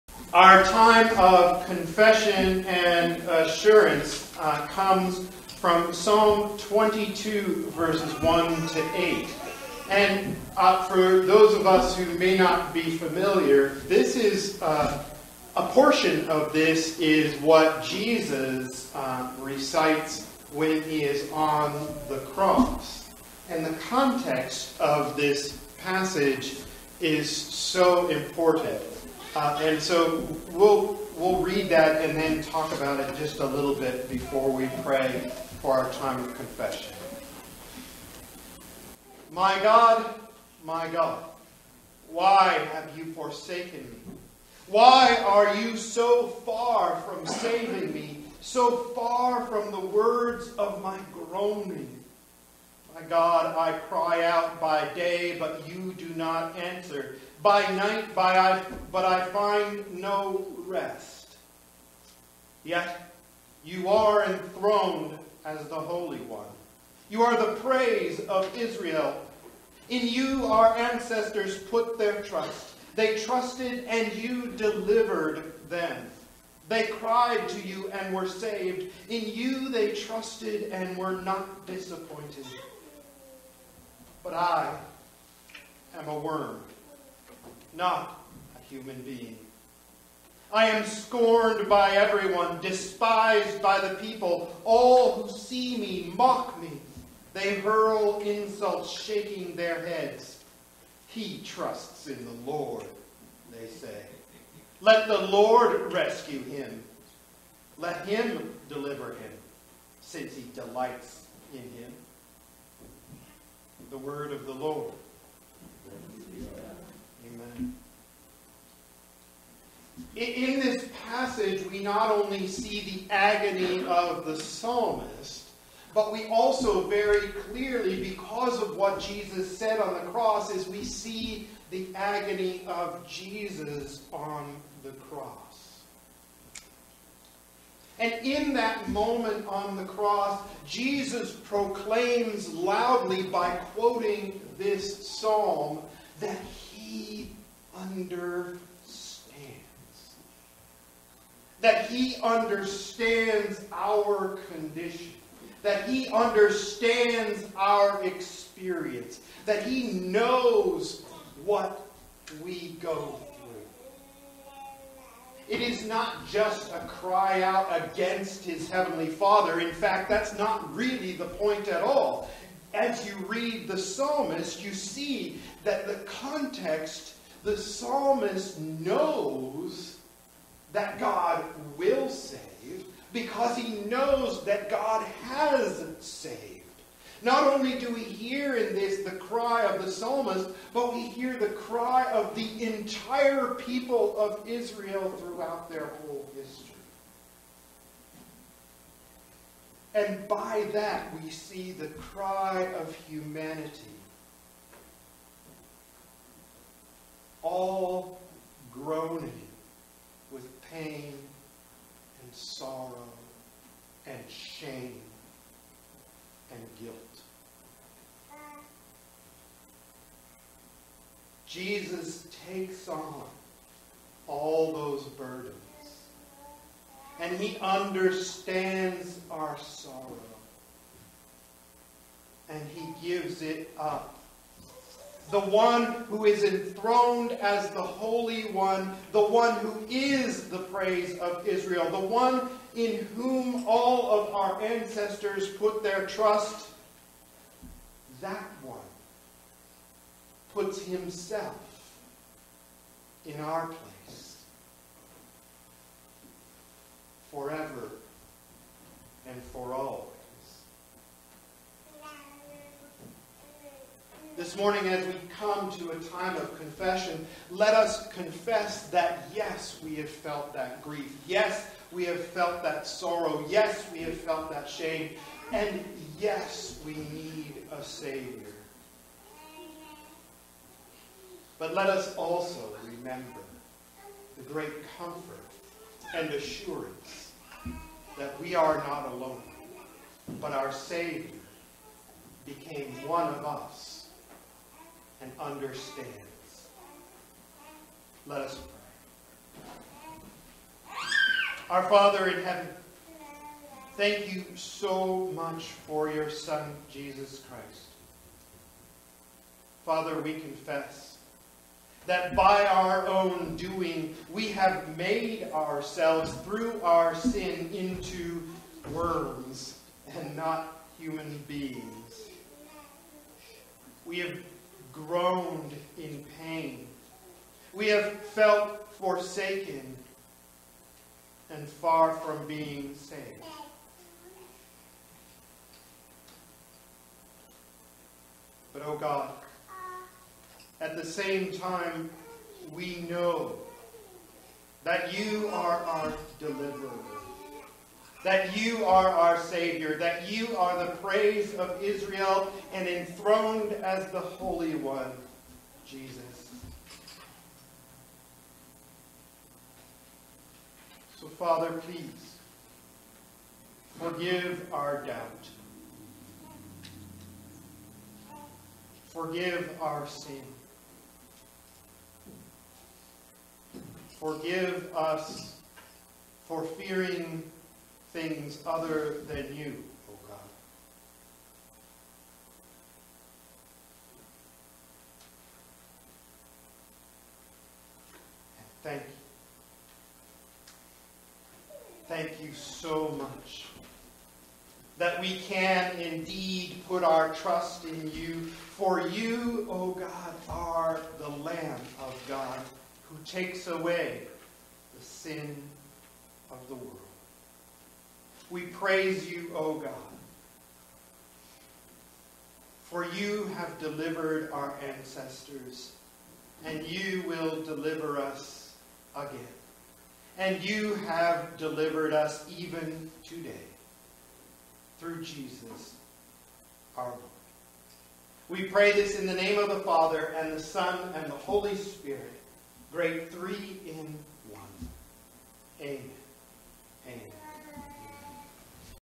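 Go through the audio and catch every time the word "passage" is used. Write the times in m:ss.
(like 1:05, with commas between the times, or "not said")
0:25, 2:01.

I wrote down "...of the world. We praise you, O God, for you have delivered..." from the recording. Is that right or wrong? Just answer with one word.
right.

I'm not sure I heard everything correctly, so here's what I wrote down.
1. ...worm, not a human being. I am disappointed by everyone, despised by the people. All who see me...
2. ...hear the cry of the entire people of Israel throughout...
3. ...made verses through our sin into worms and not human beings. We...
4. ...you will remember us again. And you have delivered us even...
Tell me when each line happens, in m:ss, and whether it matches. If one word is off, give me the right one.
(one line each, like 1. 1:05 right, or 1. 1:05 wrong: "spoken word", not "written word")
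1. 1:26 wrong: "scorned", not "disappointed"
2. 3:11 right
3. 5:14 wrong: "ourselves", not "verses"
4. 6:56 wrong: "deliver", not "remember".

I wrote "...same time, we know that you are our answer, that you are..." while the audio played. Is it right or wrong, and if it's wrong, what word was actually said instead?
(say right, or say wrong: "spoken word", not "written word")
wrong: "deliverer", not "answer".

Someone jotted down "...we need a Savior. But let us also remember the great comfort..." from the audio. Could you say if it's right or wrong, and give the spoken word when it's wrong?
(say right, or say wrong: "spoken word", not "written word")
right.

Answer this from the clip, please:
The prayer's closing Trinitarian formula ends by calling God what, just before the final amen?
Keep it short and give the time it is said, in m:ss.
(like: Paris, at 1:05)
Great three in one, at 7:12.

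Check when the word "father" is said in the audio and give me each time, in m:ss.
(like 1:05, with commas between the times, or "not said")
2:49, 5:01, 5:09, 6:01, 7:09.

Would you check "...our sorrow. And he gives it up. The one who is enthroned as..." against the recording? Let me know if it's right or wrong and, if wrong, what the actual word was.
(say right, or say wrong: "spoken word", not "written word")
right.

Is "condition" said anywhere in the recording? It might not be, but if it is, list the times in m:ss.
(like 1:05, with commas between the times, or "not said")
2:34.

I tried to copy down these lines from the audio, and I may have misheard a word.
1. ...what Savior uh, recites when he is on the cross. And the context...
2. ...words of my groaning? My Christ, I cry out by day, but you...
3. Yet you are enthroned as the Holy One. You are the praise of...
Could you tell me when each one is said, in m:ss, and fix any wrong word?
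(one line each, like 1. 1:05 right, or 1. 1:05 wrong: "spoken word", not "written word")
1. 0:17 wrong: "Jesus", not "Savior"
2. 0:49 wrong: "God", not "Christ"
3. 1:02 right.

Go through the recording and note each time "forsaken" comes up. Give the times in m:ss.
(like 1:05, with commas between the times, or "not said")
0:43, 5:28.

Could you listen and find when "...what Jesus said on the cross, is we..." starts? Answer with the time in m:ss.
2:08.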